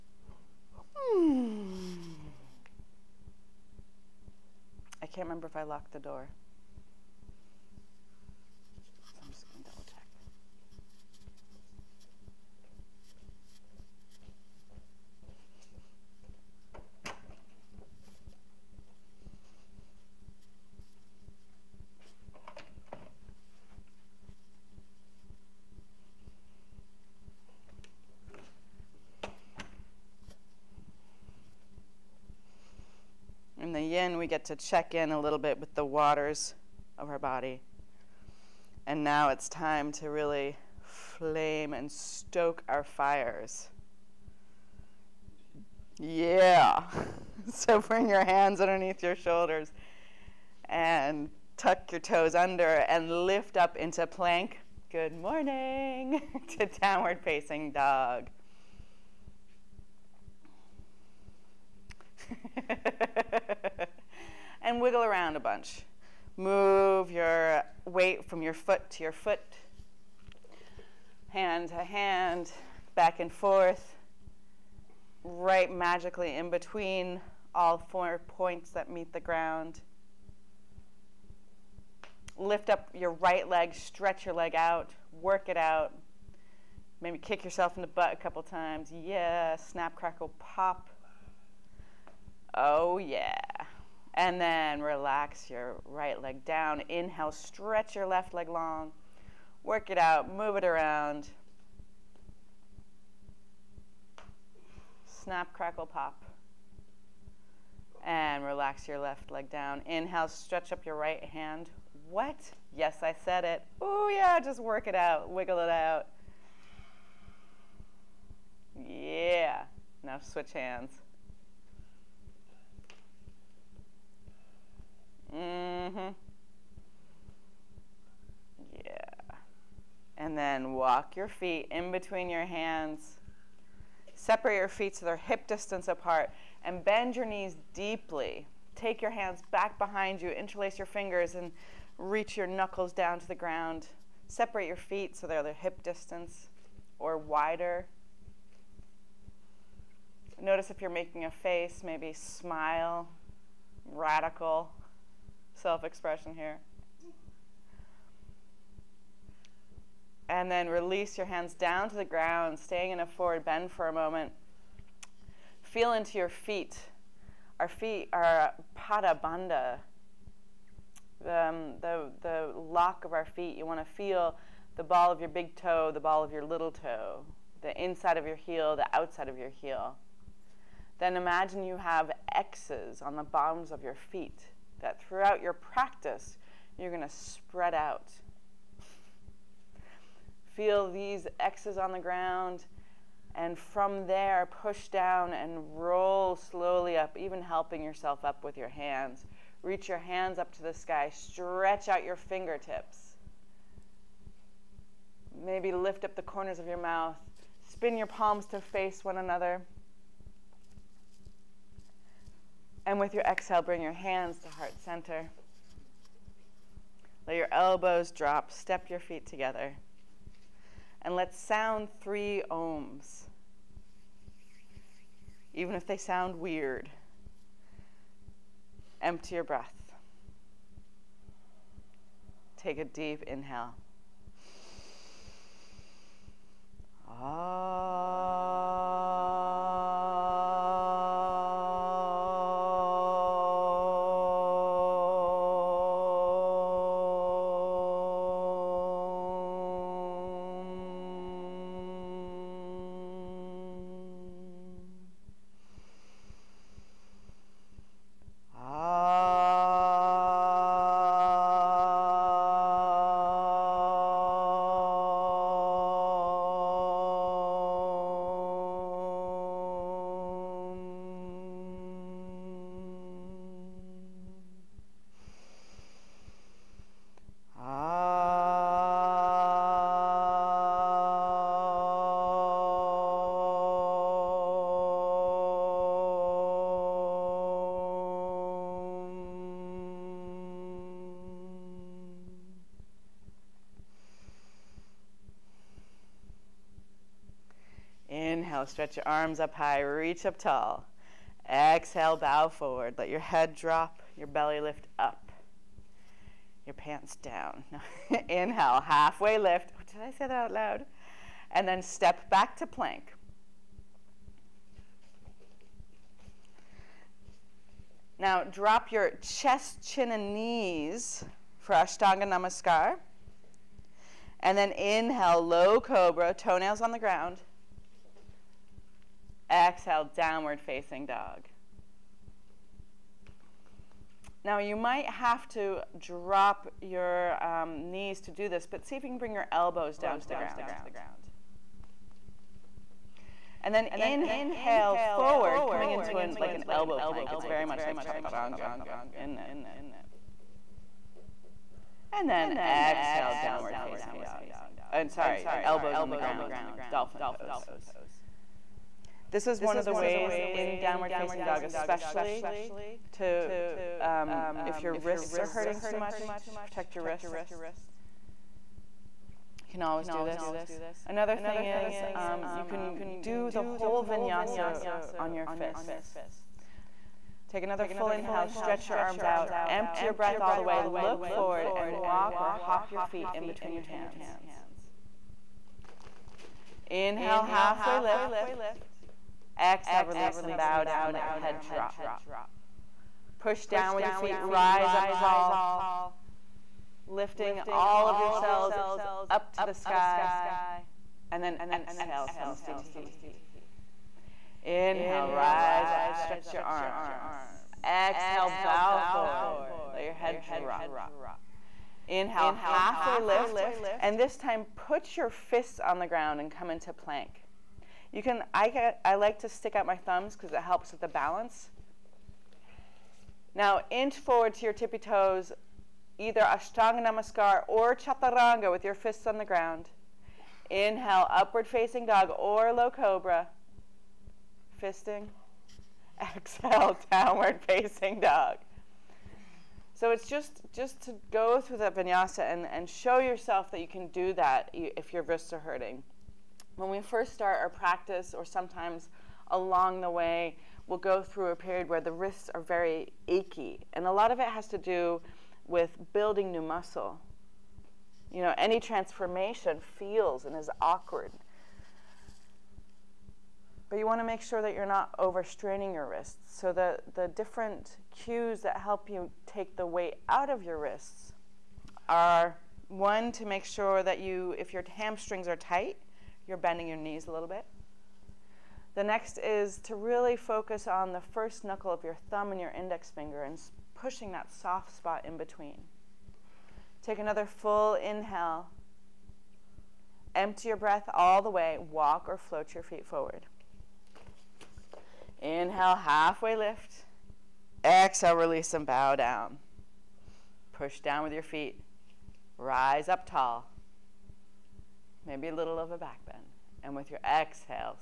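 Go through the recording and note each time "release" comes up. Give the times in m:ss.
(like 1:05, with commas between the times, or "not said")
2:40, 6:30, 8:18.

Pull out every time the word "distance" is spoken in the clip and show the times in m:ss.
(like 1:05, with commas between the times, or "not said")
2:15, 2:25.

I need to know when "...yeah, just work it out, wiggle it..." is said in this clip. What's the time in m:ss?
1:54.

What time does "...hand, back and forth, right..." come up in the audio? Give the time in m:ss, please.
1:11.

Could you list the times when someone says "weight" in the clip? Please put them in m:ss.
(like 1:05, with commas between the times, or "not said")
1:07, 7:49.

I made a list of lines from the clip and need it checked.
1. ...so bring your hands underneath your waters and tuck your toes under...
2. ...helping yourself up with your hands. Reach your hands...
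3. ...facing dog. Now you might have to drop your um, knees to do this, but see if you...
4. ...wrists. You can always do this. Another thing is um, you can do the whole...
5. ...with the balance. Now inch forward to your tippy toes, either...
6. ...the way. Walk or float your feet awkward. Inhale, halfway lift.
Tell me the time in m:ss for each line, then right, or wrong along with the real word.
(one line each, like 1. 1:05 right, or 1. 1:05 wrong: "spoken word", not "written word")
1. 0:47 wrong: "shoulders", not "waters"
2. 3:17 right
3. 5:30 right
4. 6:07 right
5. 7:00 right
6. 8:11 wrong: "forward", not "awkward".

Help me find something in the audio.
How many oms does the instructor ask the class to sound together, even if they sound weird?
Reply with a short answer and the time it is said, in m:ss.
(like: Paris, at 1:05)
3, at 3:41.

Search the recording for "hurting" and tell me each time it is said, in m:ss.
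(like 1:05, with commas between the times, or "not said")
6:05, 7:25.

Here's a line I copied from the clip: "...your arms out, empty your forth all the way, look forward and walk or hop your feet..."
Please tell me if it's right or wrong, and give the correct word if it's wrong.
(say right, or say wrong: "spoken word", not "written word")
wrong: "breath", not "forth".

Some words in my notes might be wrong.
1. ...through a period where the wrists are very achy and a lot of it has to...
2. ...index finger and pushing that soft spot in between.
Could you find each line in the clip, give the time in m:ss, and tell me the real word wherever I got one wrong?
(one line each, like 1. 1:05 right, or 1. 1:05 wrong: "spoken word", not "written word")
1. 7:31 right
2. 8:02 right.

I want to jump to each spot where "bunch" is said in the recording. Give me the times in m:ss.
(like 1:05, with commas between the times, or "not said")
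1:05.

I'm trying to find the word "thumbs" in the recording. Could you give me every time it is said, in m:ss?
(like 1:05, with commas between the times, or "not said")
6:59, 8:02.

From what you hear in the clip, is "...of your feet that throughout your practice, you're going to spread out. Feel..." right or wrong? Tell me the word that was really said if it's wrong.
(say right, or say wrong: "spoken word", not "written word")
right.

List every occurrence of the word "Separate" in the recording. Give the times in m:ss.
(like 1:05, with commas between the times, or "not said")
2:14, 2:24.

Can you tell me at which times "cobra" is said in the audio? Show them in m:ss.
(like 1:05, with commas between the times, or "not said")
5:25, 7:12.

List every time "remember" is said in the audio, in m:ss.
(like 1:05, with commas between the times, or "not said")
0:05.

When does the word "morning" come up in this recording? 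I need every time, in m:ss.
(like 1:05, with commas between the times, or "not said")
0:55.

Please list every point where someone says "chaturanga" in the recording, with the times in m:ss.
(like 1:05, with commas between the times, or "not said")
5:47, 7:07.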